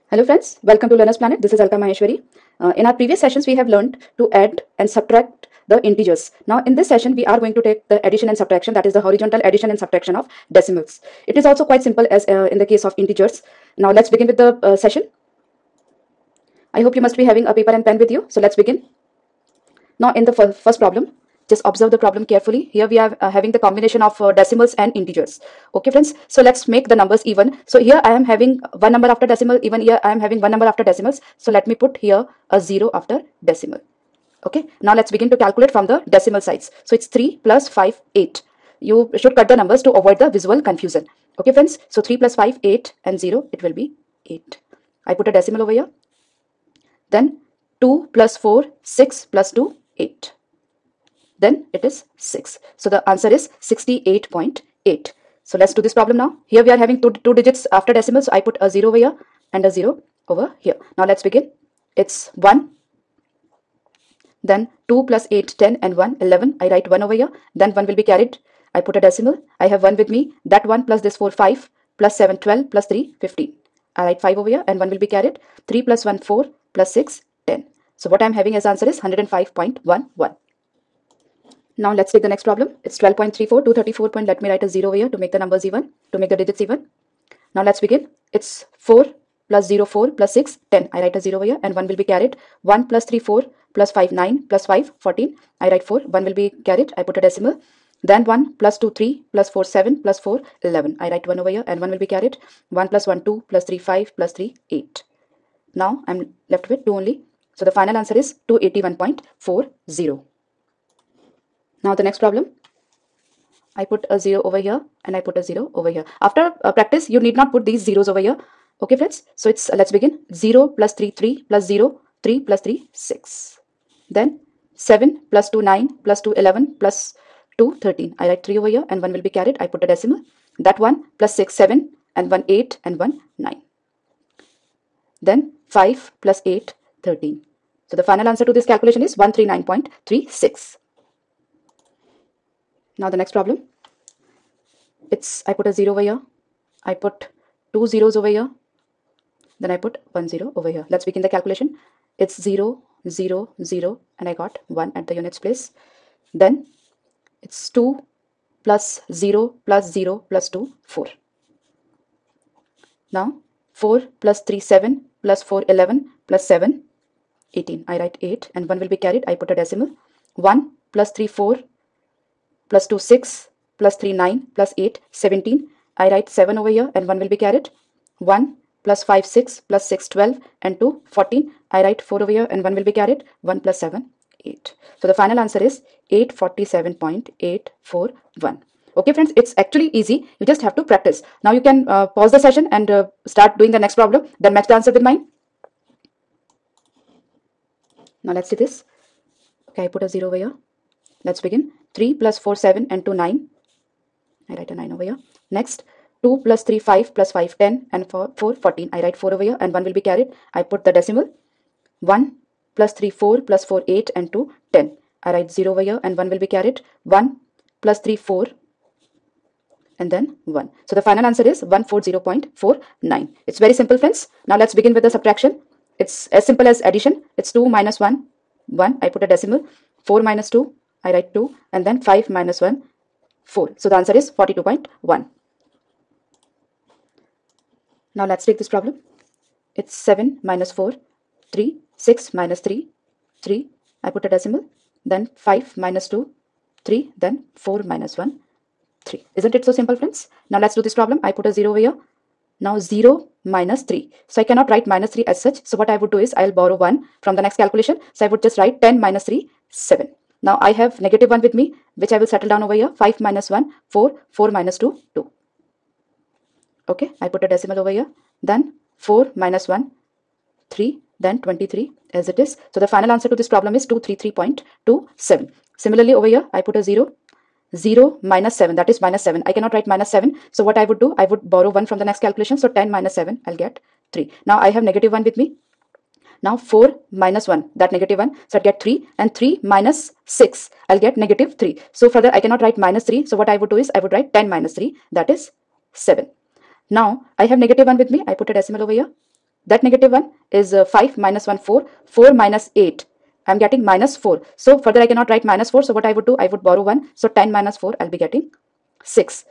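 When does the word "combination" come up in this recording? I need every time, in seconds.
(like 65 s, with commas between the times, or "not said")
23 s.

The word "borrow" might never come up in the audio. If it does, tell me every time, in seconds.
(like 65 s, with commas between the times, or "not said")
256 s, 281 s, 306 s.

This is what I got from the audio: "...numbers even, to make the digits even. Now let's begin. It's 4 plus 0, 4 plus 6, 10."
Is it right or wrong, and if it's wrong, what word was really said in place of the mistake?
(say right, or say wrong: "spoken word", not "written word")
right.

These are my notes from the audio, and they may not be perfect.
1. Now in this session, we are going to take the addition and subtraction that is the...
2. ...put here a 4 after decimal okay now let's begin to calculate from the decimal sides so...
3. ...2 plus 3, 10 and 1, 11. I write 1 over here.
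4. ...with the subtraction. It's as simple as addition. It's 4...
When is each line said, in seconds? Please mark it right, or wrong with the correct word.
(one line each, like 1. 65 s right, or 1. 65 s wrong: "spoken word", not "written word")
1. 6 s right
2. 31 s wrong: "0", not "4"
3. 64 s wrong: "8", not "3"
4. 224 s wrong: "2", not "4".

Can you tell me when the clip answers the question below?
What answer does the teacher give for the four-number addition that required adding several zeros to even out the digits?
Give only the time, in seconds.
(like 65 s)
186 s.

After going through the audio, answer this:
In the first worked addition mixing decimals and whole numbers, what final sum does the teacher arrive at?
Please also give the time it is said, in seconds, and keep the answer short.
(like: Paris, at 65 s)
68.8, at 53 s.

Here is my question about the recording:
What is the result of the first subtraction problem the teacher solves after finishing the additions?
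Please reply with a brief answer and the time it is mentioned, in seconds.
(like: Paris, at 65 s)
42.1, at 234 s.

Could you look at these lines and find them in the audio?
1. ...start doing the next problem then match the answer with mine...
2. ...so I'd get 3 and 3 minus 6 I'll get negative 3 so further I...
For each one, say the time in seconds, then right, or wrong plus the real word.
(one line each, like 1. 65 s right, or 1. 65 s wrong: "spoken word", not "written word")
1. 193 s right
2. 288 s right.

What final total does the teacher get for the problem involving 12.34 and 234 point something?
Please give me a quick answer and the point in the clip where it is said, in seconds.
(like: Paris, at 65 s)
281.40, at 108 s.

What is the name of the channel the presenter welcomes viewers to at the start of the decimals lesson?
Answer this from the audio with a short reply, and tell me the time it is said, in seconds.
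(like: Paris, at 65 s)
Learner's Planet, at 0 s.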